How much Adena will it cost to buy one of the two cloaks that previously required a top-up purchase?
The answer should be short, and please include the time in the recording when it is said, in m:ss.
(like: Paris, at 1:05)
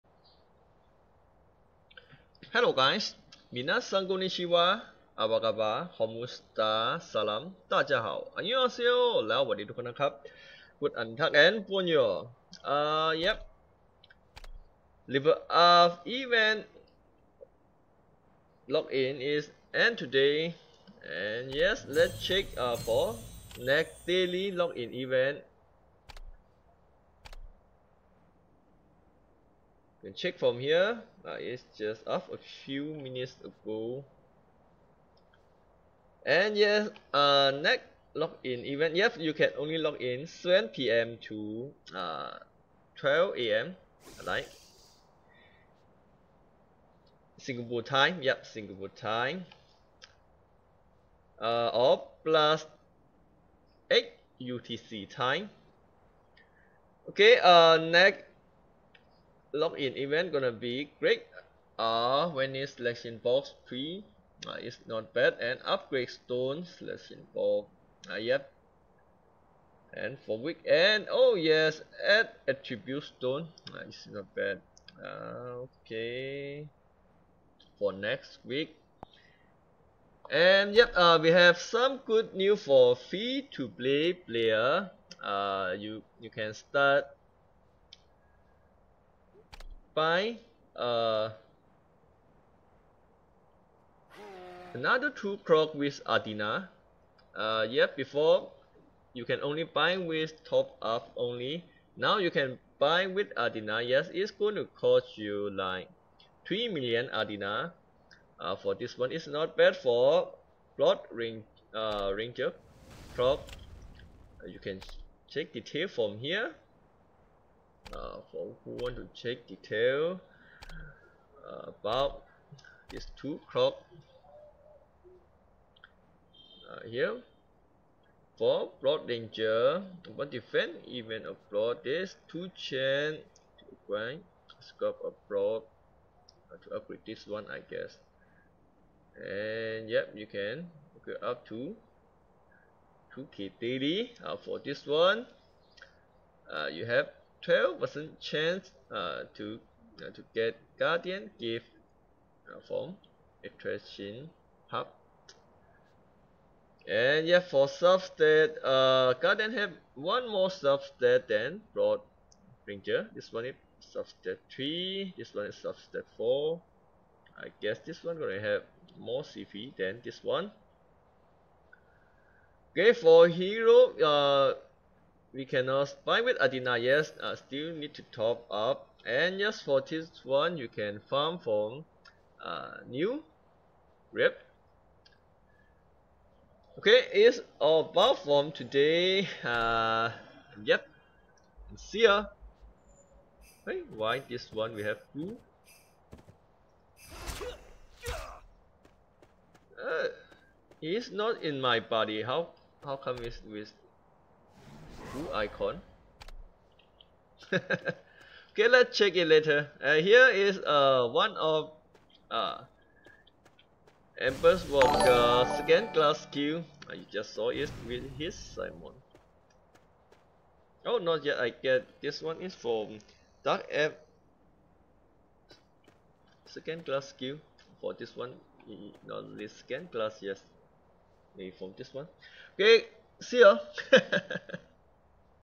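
3 million Adena, at 1:46.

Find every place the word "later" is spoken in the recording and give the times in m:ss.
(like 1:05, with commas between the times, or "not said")
3:29.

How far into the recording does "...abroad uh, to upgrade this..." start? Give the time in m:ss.
2:15.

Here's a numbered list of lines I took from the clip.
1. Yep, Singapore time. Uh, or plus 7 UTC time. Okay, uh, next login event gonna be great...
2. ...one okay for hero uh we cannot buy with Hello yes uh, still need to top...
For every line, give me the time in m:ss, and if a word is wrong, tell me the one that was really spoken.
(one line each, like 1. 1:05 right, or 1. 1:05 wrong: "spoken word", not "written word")
1. 0:48 wrong: "8", not "7"
2. 2:50 wrong: "Adena", not "Hello".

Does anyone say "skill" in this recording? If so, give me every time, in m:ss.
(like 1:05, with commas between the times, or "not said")
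3:36, 3:47.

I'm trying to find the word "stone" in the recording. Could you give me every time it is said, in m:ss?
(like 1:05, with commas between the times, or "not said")
1:06, 1:13.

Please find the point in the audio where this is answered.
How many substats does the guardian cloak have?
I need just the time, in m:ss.
2:45.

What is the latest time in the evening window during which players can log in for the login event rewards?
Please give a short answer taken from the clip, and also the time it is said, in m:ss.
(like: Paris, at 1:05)
12 a.m., at 0:42.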